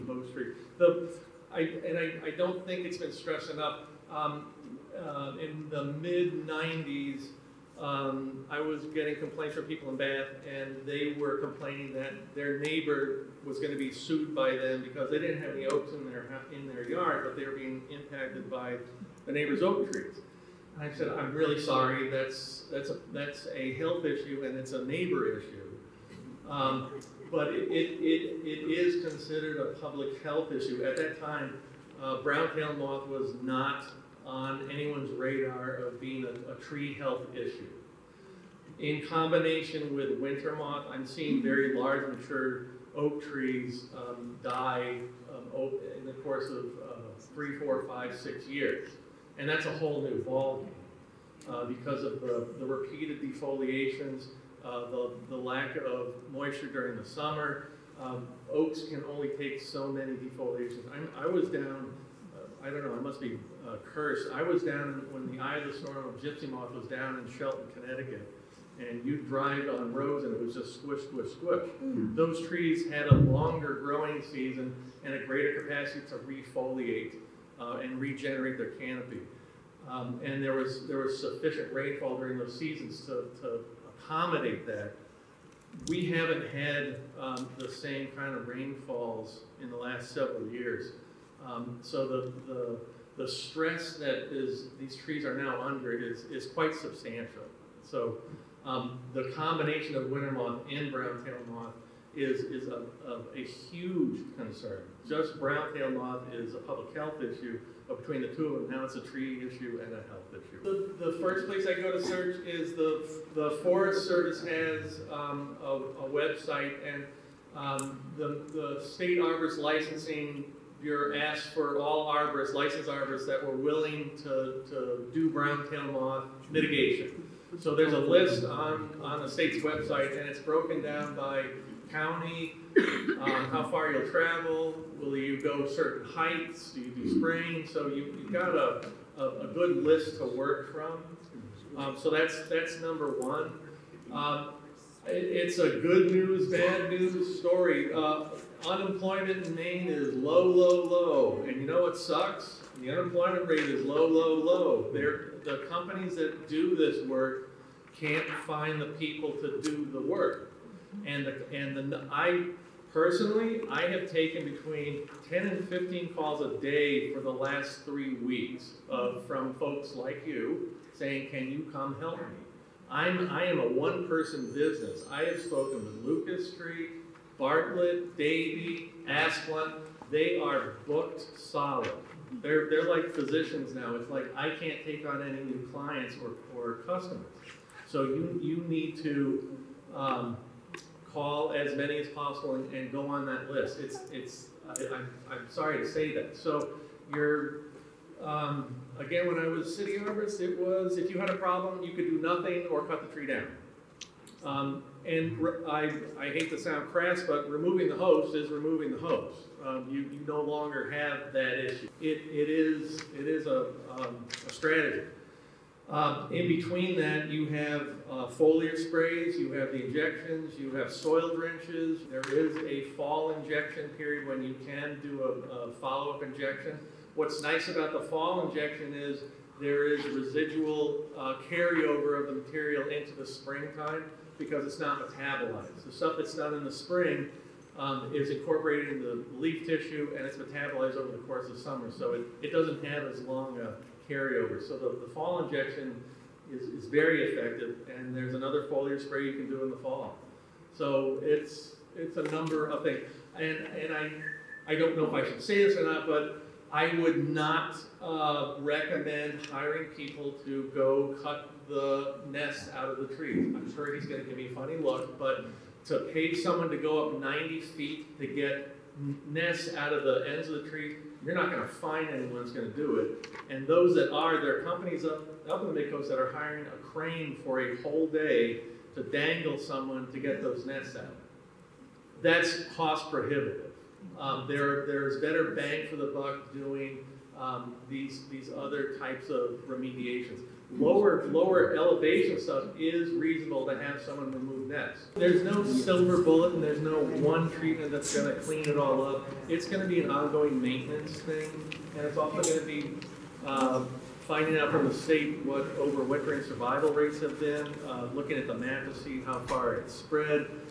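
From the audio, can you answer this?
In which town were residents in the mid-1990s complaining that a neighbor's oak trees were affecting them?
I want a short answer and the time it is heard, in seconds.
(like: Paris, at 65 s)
Bath, at 9 s.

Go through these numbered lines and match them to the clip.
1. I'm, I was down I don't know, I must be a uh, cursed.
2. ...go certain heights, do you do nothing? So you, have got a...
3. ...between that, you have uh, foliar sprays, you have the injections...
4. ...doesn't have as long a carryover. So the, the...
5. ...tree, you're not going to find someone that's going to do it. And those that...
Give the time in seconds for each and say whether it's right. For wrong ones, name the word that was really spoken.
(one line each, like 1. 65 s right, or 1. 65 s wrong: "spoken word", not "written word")
1. 60 s right
2. 135 s wrong: "spraying", not "nothing"
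3. 216 s right
4. 242 s right
5. 270 s wrong: "anyone", not "someone".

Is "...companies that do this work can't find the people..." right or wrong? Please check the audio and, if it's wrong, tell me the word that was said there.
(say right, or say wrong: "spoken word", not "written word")
right.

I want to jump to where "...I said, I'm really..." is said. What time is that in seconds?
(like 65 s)
20 s.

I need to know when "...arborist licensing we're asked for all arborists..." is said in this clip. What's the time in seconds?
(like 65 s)
119 s.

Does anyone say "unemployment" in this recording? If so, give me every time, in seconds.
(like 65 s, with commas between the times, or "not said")
148 s, 152 s.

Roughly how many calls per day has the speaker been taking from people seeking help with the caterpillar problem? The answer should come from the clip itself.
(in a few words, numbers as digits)
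10 to 15.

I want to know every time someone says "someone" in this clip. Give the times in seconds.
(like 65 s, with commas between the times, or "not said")
266 s, 279 s, 294 s.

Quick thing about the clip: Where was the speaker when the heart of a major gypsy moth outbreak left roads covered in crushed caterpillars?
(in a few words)
Shelton, Connecticut.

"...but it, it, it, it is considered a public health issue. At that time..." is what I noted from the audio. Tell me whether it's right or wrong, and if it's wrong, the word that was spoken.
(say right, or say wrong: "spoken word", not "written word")
right.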